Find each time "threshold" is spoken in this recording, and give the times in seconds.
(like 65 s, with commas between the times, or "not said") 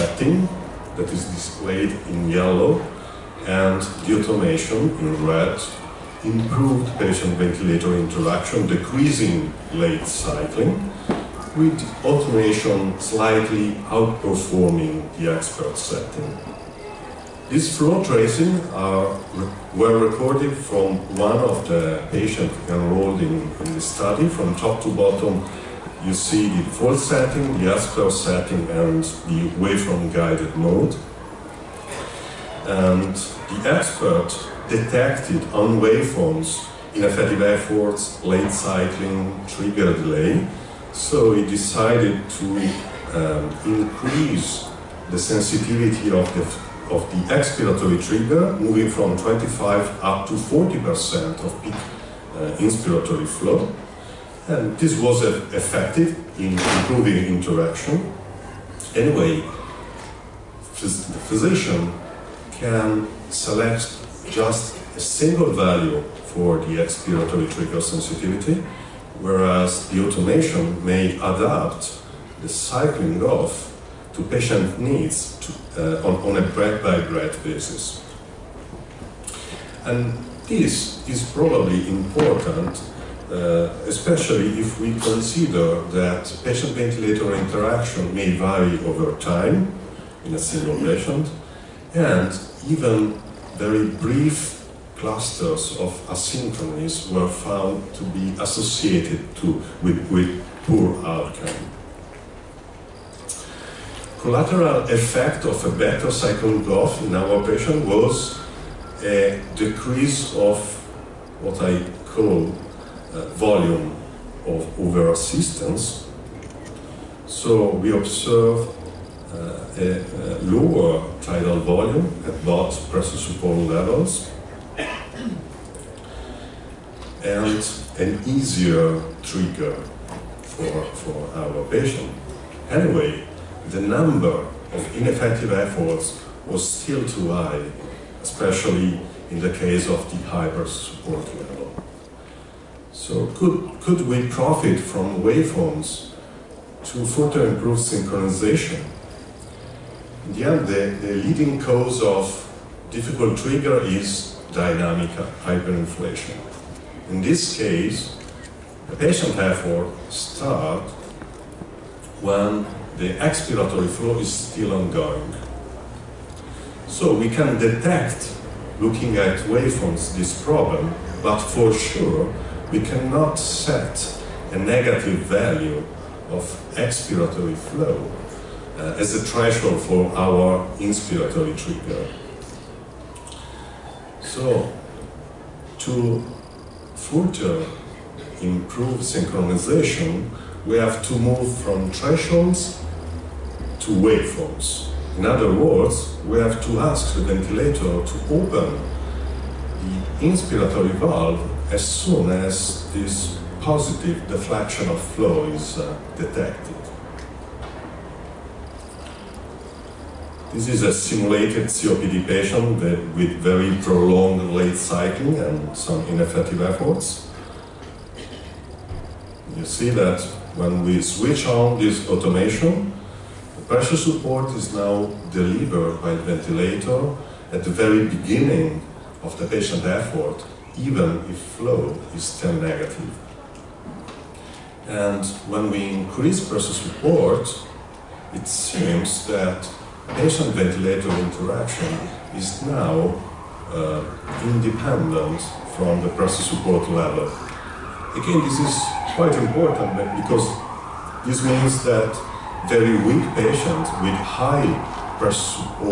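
179 s, 191 s.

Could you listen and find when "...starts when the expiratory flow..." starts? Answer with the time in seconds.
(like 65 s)
160 s.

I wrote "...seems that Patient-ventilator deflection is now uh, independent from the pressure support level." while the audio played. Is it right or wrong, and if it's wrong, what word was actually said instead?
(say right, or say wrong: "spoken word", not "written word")
wrong: "interaction", not "deflection".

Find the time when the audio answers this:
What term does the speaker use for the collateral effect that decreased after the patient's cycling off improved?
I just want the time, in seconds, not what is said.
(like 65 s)
113 s.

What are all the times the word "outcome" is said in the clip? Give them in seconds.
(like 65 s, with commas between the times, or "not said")
101 s.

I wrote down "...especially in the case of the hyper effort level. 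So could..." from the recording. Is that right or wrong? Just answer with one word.
wrong.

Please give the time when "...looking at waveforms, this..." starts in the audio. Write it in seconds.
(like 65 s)
168 s.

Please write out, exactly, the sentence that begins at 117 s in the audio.
So we observe uh, a, a lower tidal volume at both pressure support levels and an easier trigger for, for our patient.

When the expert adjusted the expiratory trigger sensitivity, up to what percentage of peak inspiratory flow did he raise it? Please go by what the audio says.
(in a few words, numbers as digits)
40%.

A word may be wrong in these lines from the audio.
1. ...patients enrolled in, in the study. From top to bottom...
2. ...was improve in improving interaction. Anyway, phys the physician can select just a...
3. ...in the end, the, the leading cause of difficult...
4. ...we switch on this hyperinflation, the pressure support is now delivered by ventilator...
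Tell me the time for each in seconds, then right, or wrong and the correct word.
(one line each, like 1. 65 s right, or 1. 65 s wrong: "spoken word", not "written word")
1. 22 s right
2. 54 s wrong: "effective", not "improve"
3. 150 s right
4. 220 s wrong: "automation", not "hyperinflation".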